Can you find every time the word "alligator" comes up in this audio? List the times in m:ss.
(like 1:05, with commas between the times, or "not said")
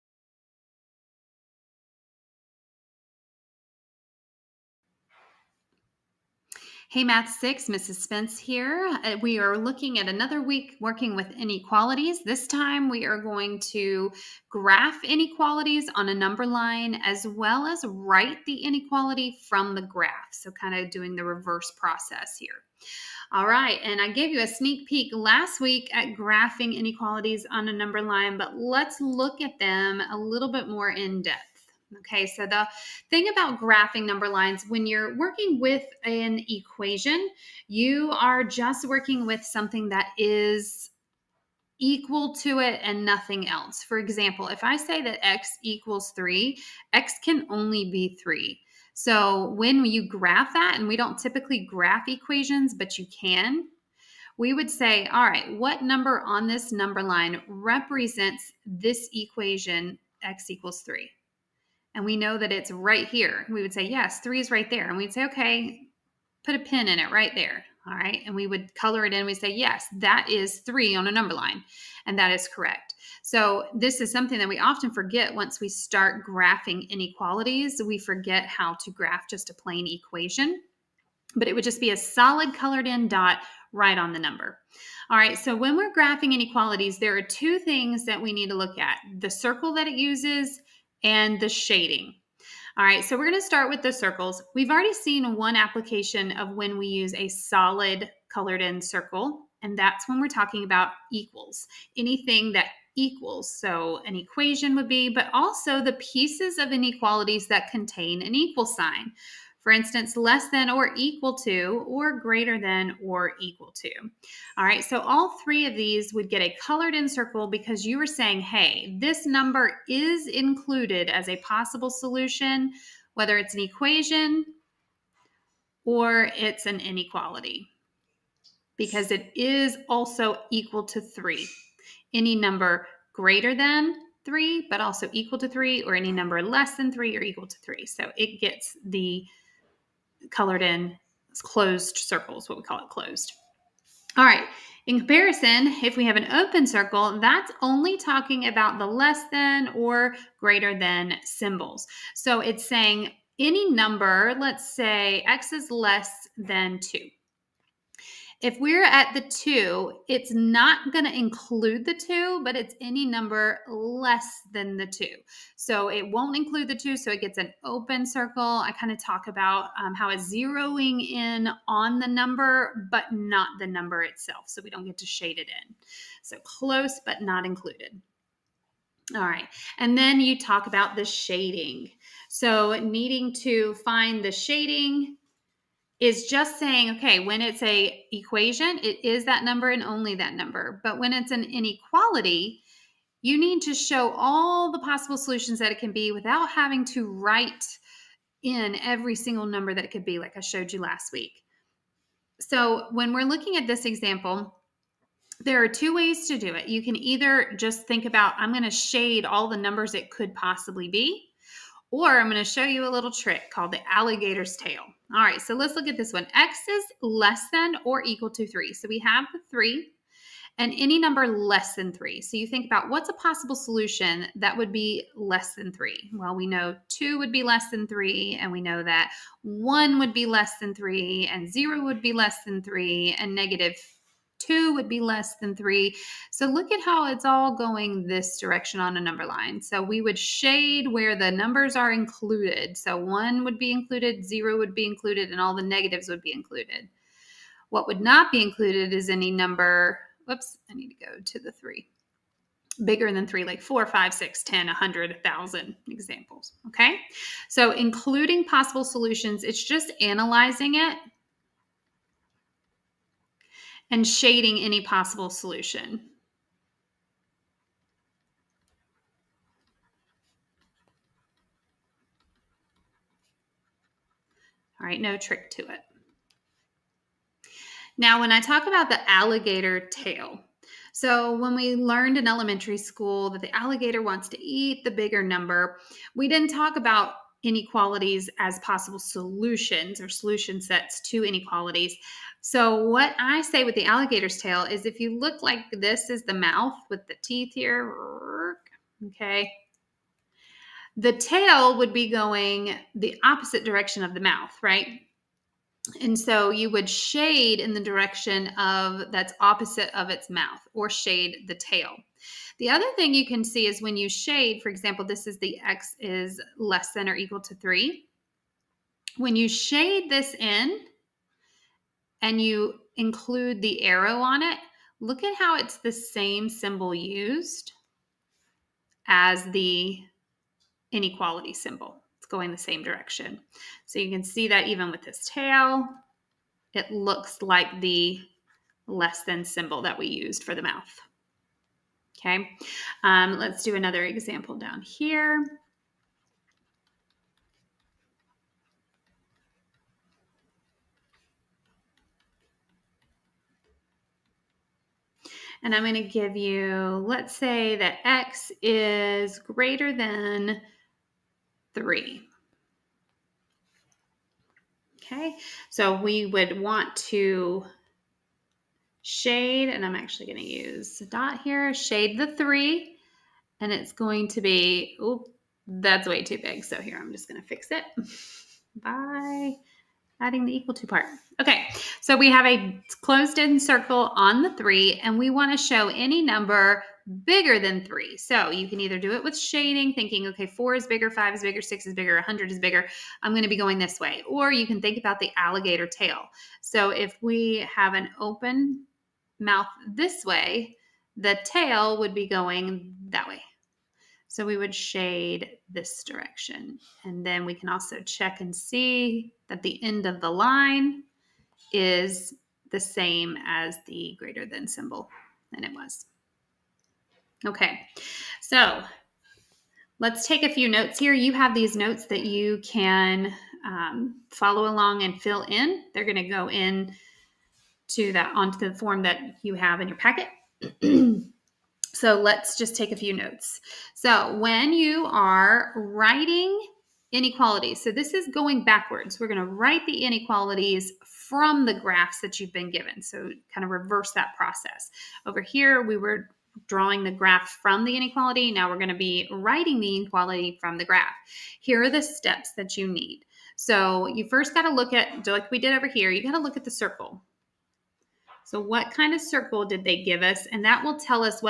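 3:33, 4:39, 4:43, 4:53, 6:35.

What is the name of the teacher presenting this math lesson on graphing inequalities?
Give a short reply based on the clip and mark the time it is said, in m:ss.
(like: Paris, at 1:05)
Mrs. Spence, at 0:07.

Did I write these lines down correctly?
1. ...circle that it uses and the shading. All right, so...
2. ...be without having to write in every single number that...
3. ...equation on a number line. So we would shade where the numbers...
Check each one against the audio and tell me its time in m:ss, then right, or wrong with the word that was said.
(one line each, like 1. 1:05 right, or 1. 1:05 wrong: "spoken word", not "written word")
1. 1:29 right
2. 3:15 right
3. 3:58 wrong: "direction", not "equation".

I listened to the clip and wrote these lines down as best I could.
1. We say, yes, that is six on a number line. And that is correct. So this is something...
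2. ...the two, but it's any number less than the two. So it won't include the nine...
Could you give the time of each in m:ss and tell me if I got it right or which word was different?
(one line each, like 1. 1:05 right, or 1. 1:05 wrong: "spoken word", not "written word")
1. 1:09 wrong: "three", not "six"
2. 2:41 wrong: "two", not "nine".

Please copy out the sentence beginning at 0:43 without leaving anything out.
For example, if I say that x equals 3, x can only be 3.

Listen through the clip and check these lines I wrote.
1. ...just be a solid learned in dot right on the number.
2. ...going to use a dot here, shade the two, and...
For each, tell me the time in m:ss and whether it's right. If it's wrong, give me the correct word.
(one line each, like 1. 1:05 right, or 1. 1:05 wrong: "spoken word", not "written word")
1. 1:21 wrong: "colored", not "learned"
2. 6:10 wrong: "three", not "two".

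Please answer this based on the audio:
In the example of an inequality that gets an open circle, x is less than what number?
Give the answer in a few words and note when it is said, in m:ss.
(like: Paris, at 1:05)
2, at 2:35.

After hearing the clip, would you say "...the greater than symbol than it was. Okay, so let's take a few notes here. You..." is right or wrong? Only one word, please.
right.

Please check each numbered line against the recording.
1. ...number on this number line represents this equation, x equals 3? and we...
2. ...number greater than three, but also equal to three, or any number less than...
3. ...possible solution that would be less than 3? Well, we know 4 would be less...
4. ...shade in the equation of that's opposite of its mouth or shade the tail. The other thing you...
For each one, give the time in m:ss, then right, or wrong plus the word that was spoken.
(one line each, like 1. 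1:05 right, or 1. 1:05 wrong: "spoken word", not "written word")
1. 0:55 right
2. 2:12 right
3. 3:43 wrong: "2", not "4"
4. 5:06 wrong: "direction", not "equation".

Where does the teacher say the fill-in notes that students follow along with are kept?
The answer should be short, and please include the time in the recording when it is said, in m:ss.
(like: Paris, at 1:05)
in your packet, at 7:09.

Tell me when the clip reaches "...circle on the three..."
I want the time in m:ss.
6:23.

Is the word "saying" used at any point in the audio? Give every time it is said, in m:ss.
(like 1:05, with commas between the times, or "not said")
1:58, 2:32, 3:06.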